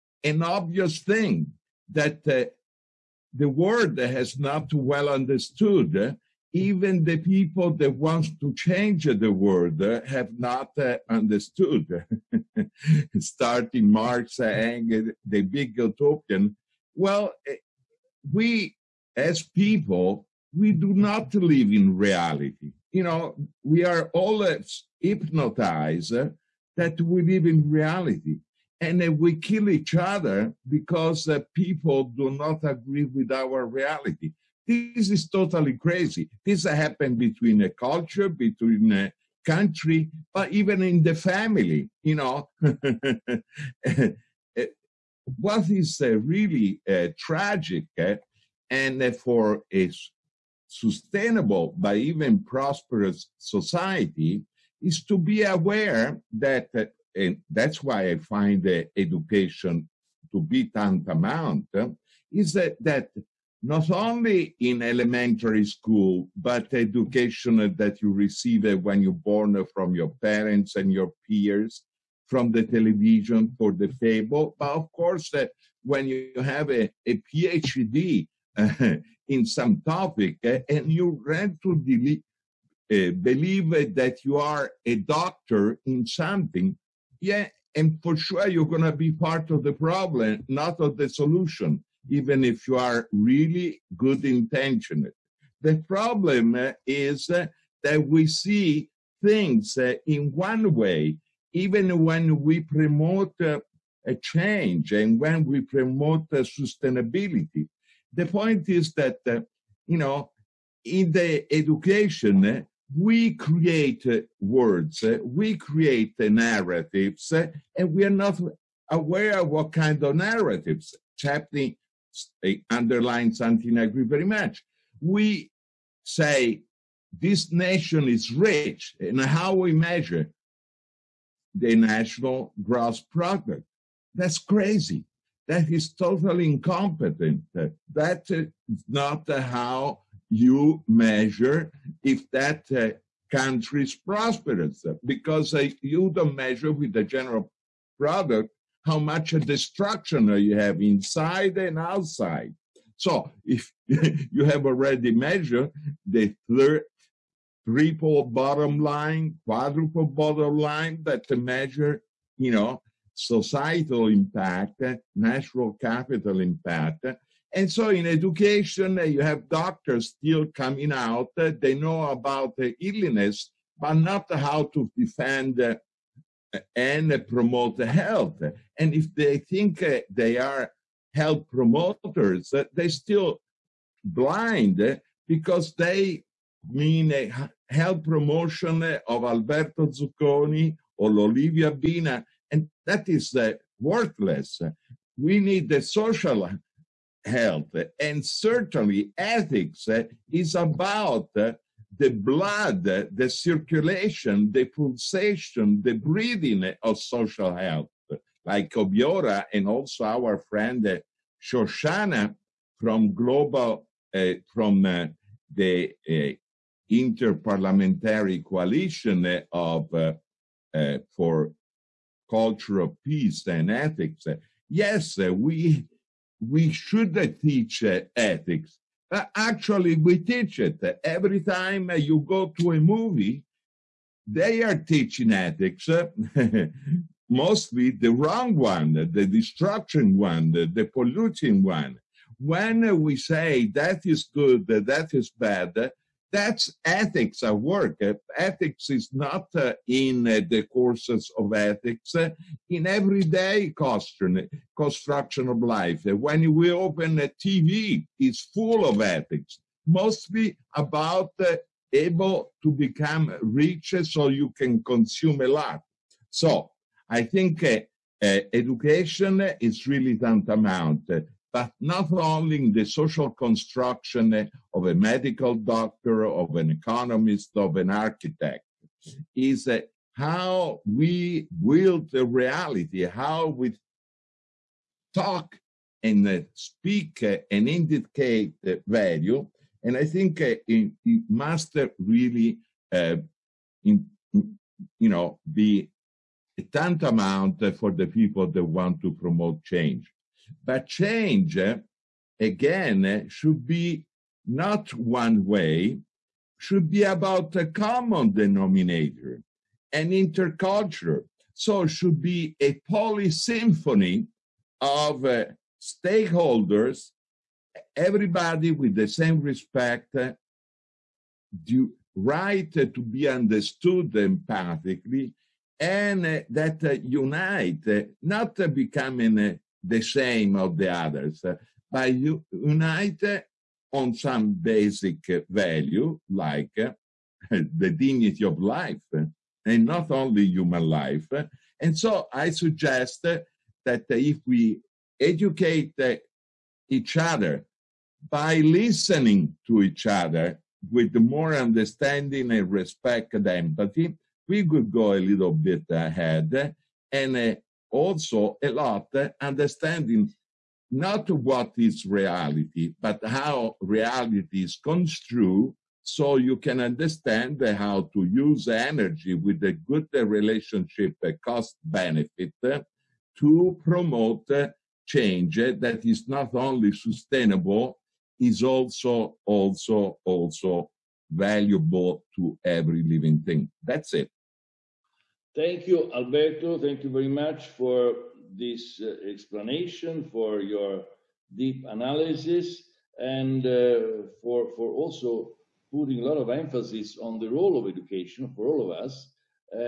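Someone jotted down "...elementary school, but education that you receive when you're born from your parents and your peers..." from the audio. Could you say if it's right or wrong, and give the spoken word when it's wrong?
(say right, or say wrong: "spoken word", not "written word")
right.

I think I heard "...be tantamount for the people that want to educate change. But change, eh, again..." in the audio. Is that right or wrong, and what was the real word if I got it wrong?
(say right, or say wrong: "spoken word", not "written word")
wrong: "promote", not "educate".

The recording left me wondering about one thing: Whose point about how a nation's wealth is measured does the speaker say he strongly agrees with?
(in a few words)
Çepni.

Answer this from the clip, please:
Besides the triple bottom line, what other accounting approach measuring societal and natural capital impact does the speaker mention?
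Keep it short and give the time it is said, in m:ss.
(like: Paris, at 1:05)
quadruple bottom line, at 2:39.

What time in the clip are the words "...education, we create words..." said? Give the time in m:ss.
1:51.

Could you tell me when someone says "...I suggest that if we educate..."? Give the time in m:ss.
5:42.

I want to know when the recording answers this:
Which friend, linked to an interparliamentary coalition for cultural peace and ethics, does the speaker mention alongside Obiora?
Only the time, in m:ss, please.
3:31.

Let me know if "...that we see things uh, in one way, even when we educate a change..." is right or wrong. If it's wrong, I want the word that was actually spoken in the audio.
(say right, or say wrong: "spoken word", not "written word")
wrong: "promote", not "educate".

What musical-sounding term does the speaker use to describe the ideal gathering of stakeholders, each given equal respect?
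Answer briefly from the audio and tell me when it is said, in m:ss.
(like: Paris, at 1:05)
polysymphony, at 5:12.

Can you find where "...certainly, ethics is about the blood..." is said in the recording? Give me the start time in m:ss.
3:18.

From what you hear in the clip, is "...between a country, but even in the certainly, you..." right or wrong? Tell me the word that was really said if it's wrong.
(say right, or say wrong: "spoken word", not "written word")
wrong: "family", not "certainly".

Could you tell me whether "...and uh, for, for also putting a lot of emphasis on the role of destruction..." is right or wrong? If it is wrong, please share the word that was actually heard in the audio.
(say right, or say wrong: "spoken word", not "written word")
wrong: "education", not "destruction".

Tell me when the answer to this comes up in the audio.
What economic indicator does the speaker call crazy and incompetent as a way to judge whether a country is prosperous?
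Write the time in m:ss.
2:11.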